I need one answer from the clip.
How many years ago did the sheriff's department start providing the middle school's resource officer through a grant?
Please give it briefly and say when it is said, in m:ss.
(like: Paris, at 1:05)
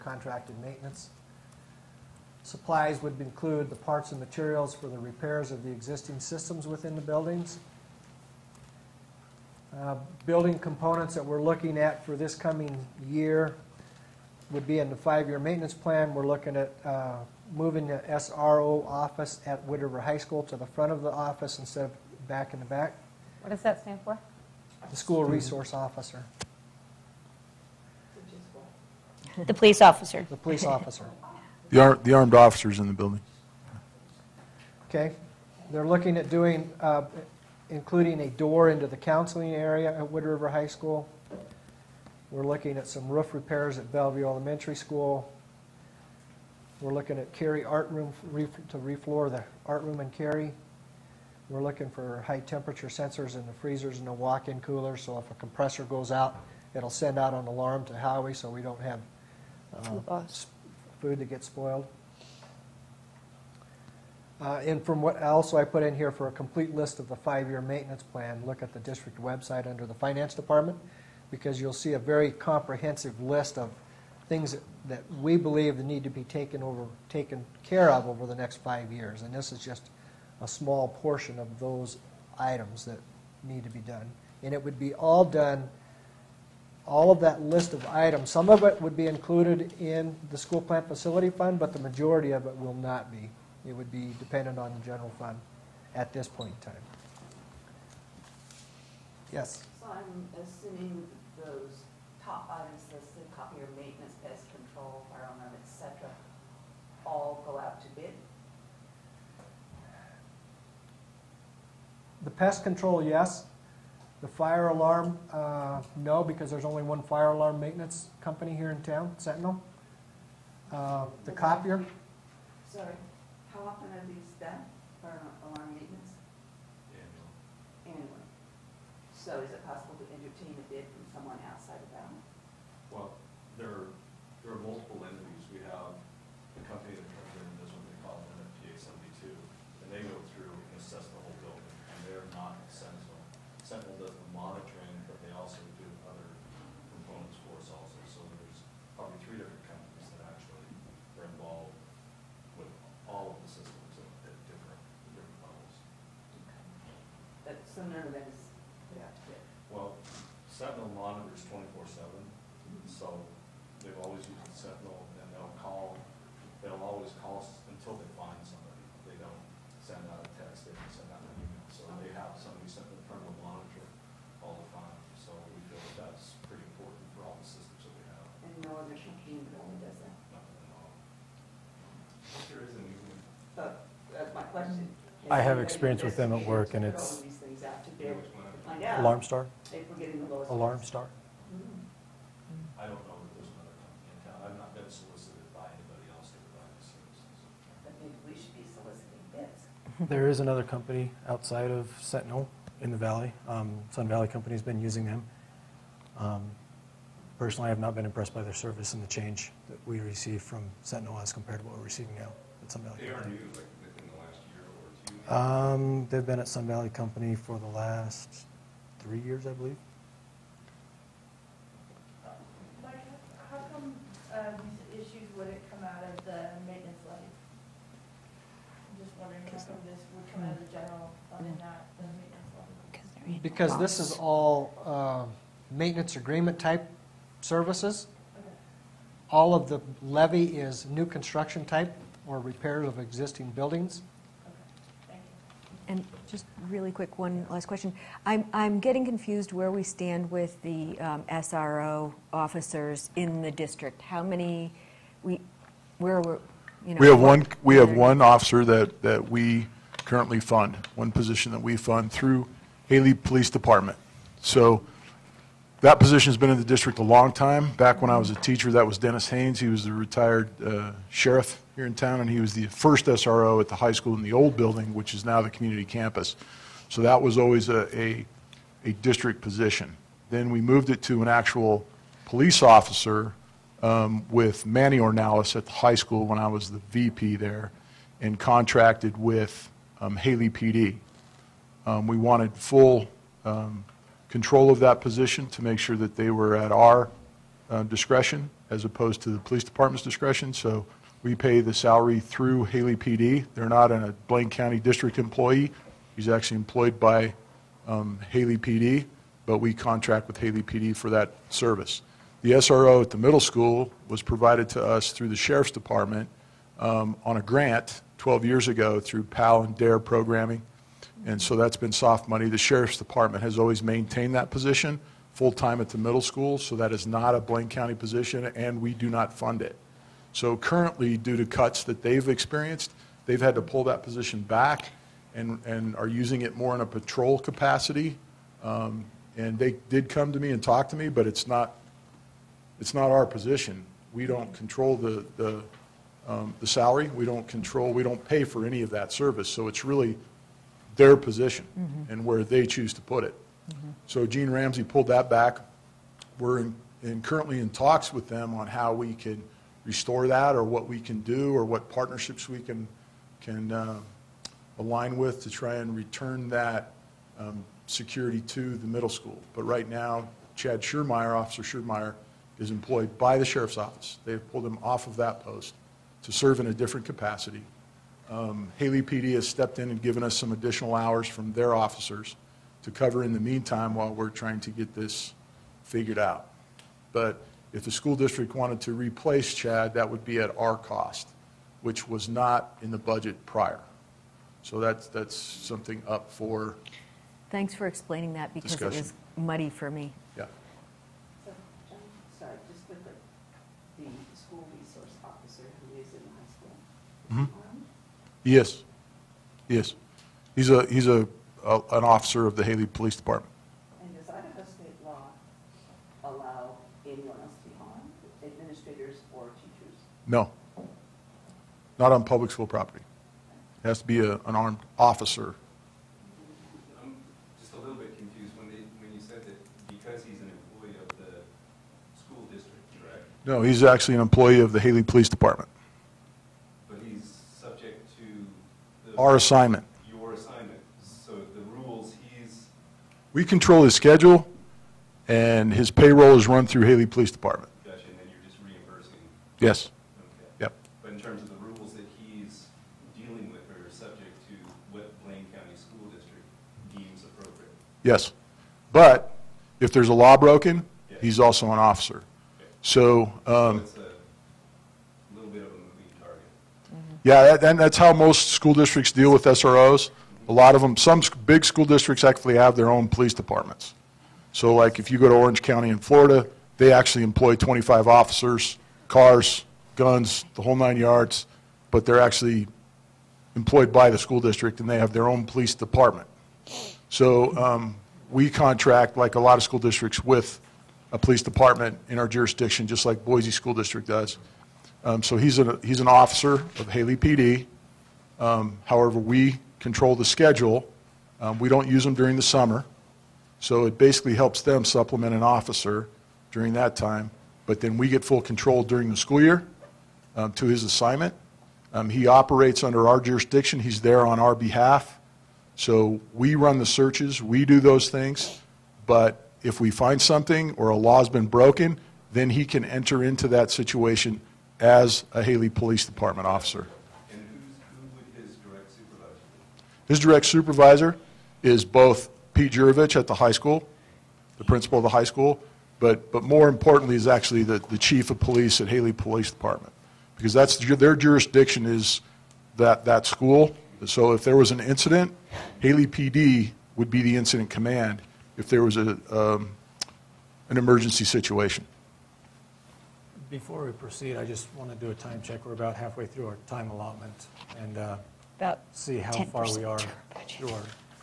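12, at 5:18.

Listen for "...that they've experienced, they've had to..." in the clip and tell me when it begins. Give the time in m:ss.
5:31.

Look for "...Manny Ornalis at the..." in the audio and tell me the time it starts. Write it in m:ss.
4:44.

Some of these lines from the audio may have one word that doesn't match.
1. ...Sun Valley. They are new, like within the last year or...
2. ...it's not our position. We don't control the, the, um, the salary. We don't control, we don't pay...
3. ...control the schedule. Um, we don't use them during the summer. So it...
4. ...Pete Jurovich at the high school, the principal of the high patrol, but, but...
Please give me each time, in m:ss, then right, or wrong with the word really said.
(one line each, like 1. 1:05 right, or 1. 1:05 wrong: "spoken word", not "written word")
1. 3:32 right
2. 5:42 right
3. 8:19 right
4. 8:52 wrong: "school", not "patrol".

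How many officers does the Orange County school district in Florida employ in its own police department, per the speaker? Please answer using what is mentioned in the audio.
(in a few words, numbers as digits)
25.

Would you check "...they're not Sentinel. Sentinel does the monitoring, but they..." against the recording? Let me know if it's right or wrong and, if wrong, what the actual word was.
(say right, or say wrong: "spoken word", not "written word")
right.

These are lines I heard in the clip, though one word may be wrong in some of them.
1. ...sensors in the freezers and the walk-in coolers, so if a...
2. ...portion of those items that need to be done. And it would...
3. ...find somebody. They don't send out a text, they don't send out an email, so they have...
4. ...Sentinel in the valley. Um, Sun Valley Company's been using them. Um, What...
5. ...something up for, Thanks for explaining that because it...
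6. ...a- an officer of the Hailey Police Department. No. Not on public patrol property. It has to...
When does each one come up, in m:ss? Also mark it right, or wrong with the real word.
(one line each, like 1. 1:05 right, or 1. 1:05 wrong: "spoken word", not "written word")
1. 0:52 right
2. 1:21 right
3. 2:48 right
4. 3:22 wrong: "Personally", not "What"
5. 6:35 right
6. 6:51 wrong: "school", not "patrol".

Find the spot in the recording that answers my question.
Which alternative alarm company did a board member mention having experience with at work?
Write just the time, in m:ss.
3:08.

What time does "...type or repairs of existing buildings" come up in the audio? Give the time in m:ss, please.
4:01.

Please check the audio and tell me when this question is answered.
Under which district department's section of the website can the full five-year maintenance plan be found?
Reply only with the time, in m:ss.
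1:09.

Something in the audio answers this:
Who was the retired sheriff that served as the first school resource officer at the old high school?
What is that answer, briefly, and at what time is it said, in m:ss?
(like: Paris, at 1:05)
Dennis Haynes, at 4:28.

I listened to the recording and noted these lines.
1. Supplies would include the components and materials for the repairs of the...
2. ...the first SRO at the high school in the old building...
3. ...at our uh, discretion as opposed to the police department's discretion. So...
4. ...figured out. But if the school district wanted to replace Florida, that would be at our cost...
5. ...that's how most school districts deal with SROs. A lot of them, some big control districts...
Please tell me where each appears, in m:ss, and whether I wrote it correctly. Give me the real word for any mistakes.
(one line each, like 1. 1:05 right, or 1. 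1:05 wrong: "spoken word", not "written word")
1. 0:02 wrong: "parts", not "components"
2. 4:32 right
3. 4:56 right
4. 6:25 wrong: "Chad", not "Florida"
5. 7:47 wrong: "school", not "control".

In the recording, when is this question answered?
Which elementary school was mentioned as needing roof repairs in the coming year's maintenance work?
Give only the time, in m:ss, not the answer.
0:43.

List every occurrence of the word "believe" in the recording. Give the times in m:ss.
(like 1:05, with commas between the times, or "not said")
1:15, 3:39.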